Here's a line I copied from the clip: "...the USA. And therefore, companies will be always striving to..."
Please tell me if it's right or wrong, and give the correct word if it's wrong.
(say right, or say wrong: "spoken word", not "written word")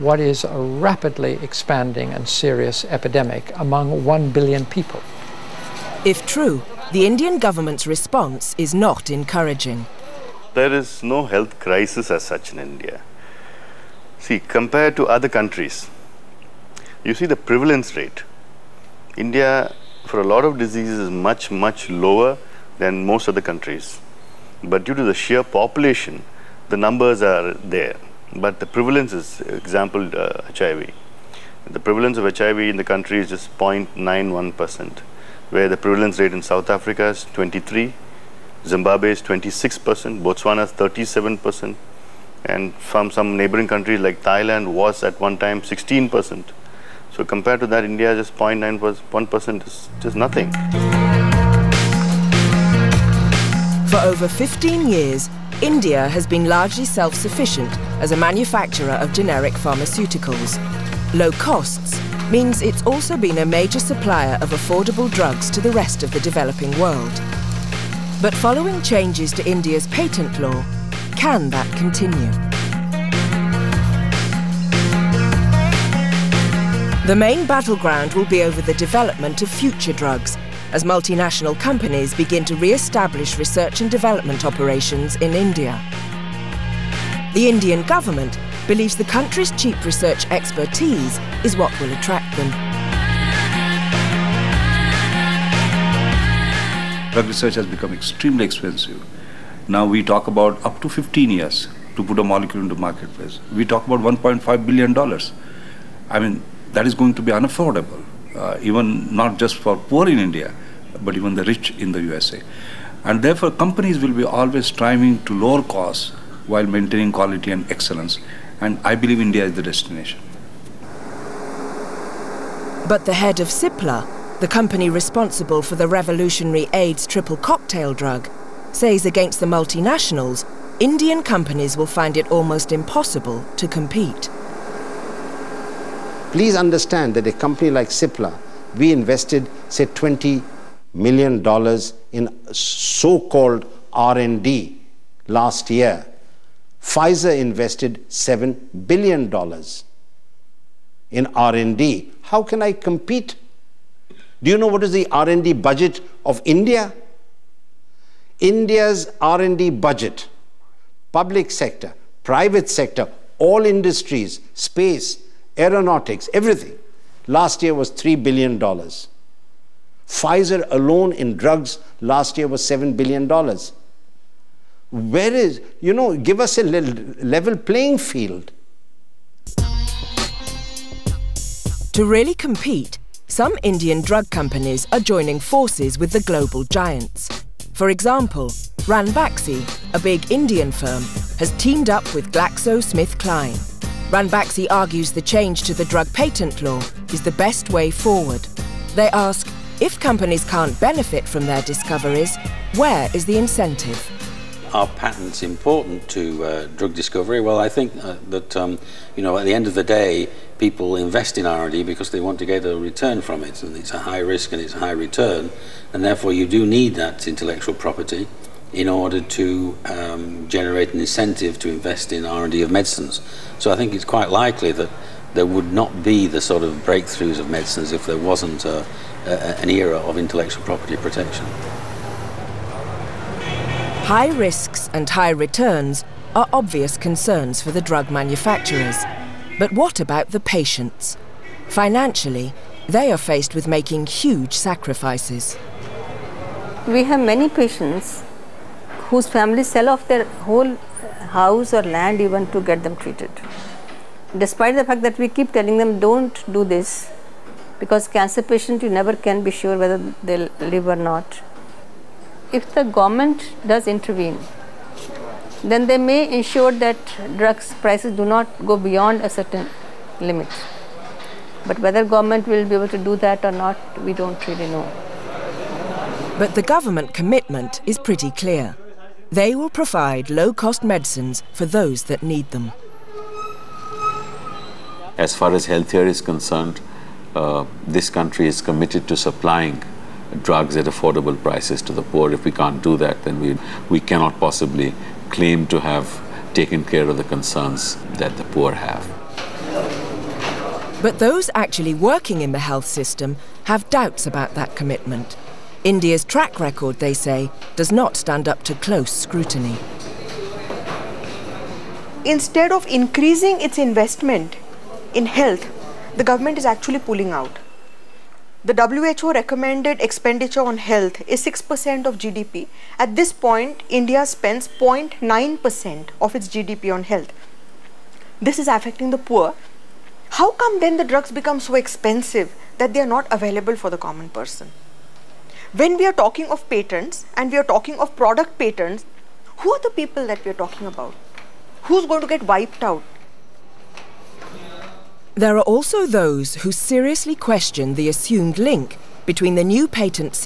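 right.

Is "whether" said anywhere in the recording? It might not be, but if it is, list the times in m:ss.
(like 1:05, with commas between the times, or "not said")
4:19, 4:31.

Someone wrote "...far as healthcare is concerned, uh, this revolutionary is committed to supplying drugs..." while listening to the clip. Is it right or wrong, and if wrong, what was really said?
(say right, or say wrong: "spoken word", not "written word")
wrong: "country", not "revolutionary".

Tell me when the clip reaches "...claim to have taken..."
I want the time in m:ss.
4:55.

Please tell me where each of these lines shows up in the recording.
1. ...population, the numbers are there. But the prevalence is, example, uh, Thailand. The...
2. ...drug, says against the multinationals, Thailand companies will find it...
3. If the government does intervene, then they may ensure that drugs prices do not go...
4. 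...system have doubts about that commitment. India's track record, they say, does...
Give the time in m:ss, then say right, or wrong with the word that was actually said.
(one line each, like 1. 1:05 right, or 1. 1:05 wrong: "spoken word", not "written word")
1. 0:25 wrong: "HIV", not "Thailand"
2. 2:07 wrong: "Indian", not "Thailand"
3. 4:22 right
4. 5:02 right.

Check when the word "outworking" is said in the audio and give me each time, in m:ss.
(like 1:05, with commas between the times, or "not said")
not said.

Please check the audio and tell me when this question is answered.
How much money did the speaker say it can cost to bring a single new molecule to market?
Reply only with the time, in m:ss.
1:43.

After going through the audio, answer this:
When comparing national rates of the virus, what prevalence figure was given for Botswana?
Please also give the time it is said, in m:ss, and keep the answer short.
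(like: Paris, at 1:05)
37%, at 0:40.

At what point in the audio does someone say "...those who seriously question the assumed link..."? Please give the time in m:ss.
5:46.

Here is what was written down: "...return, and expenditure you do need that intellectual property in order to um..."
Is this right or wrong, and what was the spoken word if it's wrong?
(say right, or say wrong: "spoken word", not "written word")
wrong: "therefore", not "expenditure".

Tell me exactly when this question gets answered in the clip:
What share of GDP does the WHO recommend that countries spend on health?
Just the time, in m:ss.
5:21.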